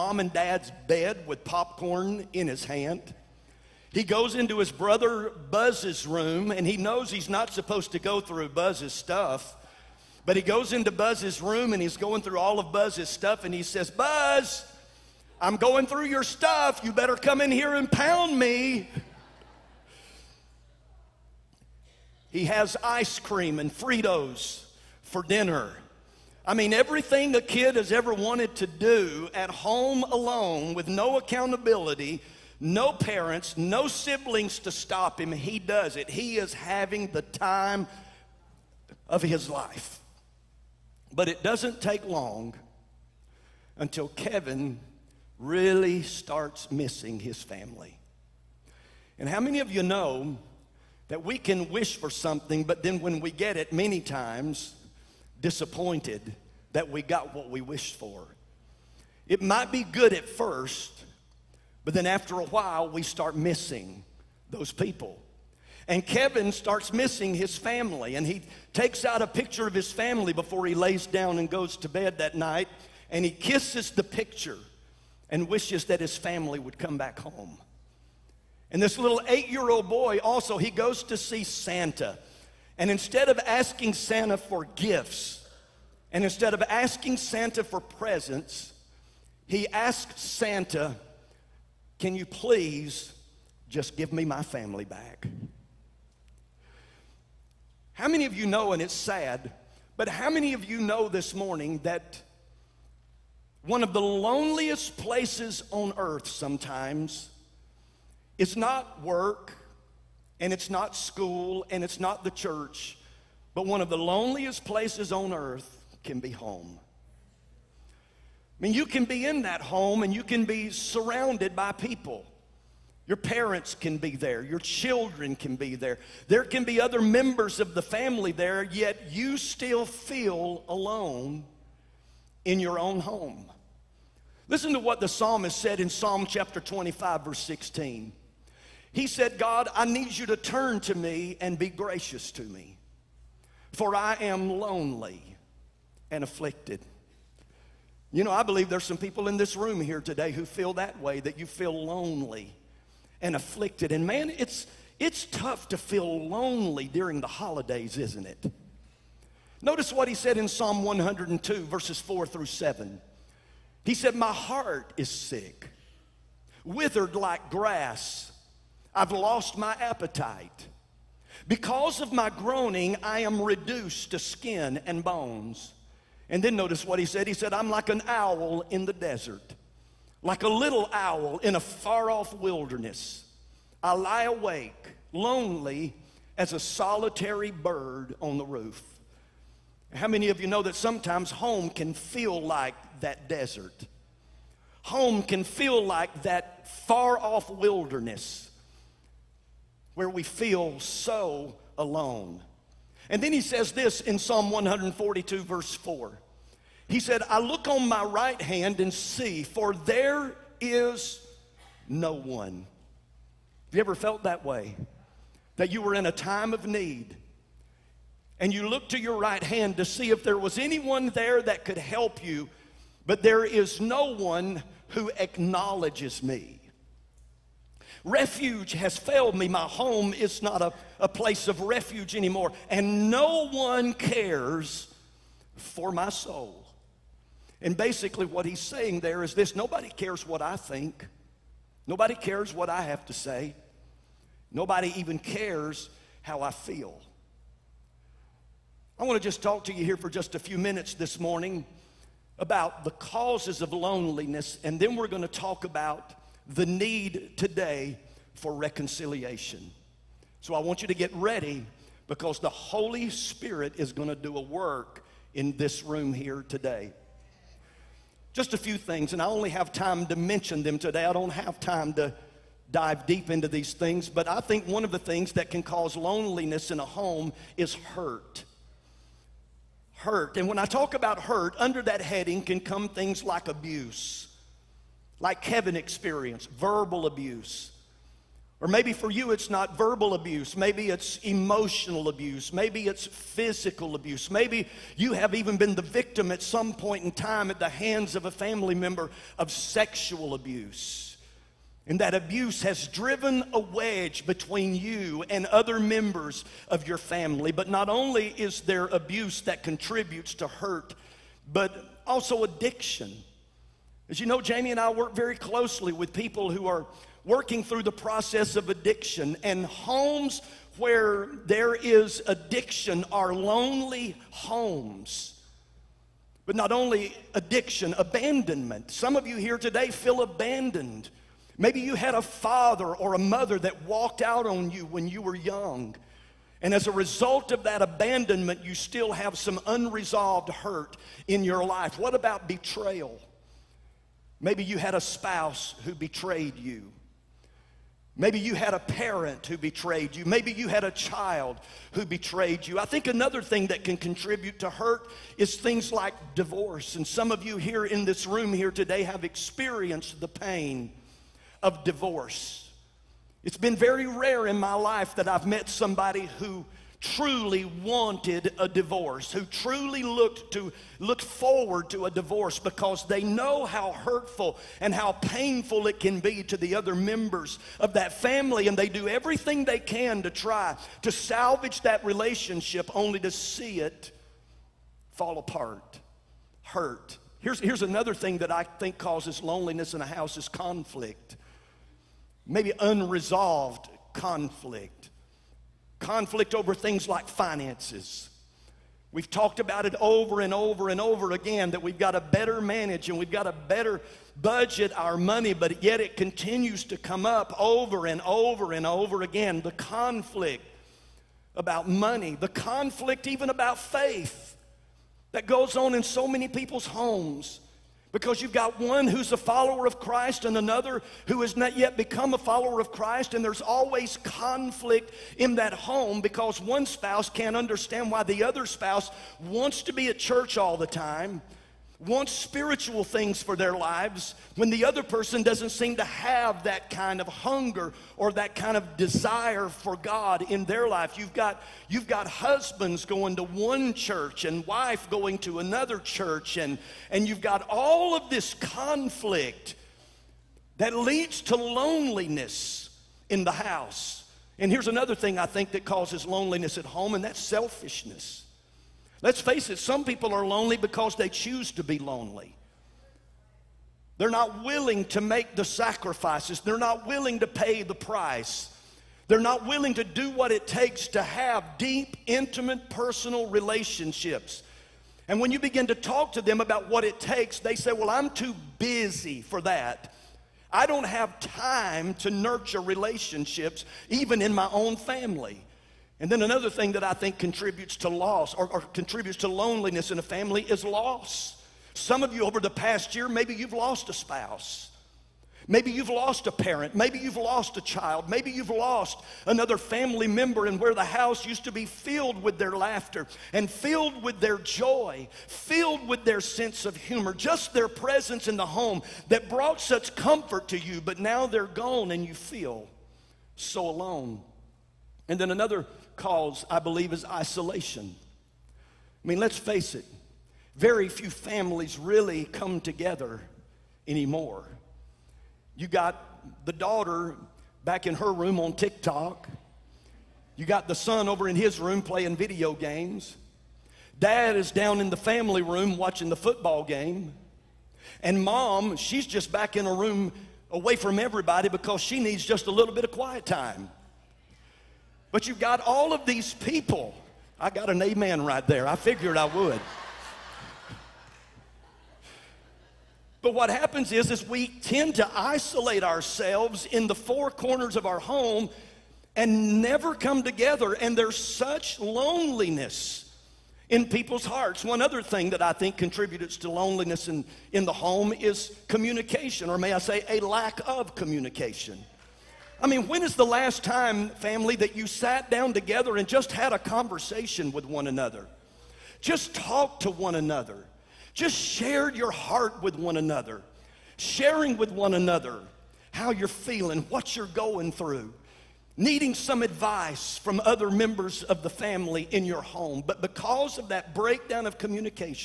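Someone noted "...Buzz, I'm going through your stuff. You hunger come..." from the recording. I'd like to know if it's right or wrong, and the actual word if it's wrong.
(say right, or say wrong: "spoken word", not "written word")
wrong: "better", not "hunger".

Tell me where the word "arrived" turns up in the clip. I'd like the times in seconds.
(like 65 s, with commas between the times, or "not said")
not said.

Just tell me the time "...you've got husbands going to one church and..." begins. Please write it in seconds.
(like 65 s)
441 s.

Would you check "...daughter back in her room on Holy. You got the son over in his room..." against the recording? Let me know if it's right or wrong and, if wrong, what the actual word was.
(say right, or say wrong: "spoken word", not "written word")
wrong: "TikTok", not "Holy".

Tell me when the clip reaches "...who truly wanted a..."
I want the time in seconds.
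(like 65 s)
366 s.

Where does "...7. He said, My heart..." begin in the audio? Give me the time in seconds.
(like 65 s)
162 s.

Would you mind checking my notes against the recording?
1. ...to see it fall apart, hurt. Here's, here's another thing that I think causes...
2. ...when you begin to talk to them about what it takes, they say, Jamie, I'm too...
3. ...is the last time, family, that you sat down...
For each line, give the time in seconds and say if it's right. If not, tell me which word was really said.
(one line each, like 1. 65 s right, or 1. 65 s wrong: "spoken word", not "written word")
1. 383 s right
2. 475 s wrong: "Well", not "Jamie"
3. 573 s right.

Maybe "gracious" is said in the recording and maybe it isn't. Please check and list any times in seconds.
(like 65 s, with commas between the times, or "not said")
141 s.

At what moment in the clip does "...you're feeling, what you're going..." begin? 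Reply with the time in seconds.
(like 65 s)
586 s.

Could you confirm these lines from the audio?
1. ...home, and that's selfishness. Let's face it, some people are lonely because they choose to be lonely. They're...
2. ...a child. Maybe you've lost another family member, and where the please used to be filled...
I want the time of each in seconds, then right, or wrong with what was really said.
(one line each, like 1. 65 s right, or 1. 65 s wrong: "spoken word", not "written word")
1. 456 s right
2. 497 s wrong: "house", not "please".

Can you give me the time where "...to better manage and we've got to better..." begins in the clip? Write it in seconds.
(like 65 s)
402 s.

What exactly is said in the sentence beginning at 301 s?
And that abuse has driven a wedge between you and other members of your family.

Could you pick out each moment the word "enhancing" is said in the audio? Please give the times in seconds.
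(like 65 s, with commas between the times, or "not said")
not said.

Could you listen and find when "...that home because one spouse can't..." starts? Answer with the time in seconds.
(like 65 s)
425 s.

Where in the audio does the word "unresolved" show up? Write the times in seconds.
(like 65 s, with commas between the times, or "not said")
339 s, 392 s.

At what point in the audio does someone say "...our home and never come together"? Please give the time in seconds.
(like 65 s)
558 s.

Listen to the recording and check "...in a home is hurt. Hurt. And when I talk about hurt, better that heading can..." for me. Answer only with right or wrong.
wrong.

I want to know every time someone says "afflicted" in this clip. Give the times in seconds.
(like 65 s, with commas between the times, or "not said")
146 s, 153 s.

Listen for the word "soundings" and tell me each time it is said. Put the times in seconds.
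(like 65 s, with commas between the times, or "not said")
not said.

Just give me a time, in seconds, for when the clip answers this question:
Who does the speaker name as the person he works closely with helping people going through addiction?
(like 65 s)
314 s.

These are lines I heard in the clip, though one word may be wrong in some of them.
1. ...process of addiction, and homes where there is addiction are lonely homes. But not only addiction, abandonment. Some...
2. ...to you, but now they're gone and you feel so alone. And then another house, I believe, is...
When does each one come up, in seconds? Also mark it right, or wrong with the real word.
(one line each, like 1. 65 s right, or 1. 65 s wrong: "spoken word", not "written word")
1. 317 s right
2. 510 s wrong: "cause", not "house".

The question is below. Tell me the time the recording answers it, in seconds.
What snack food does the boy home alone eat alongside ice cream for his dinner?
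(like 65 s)
23 s.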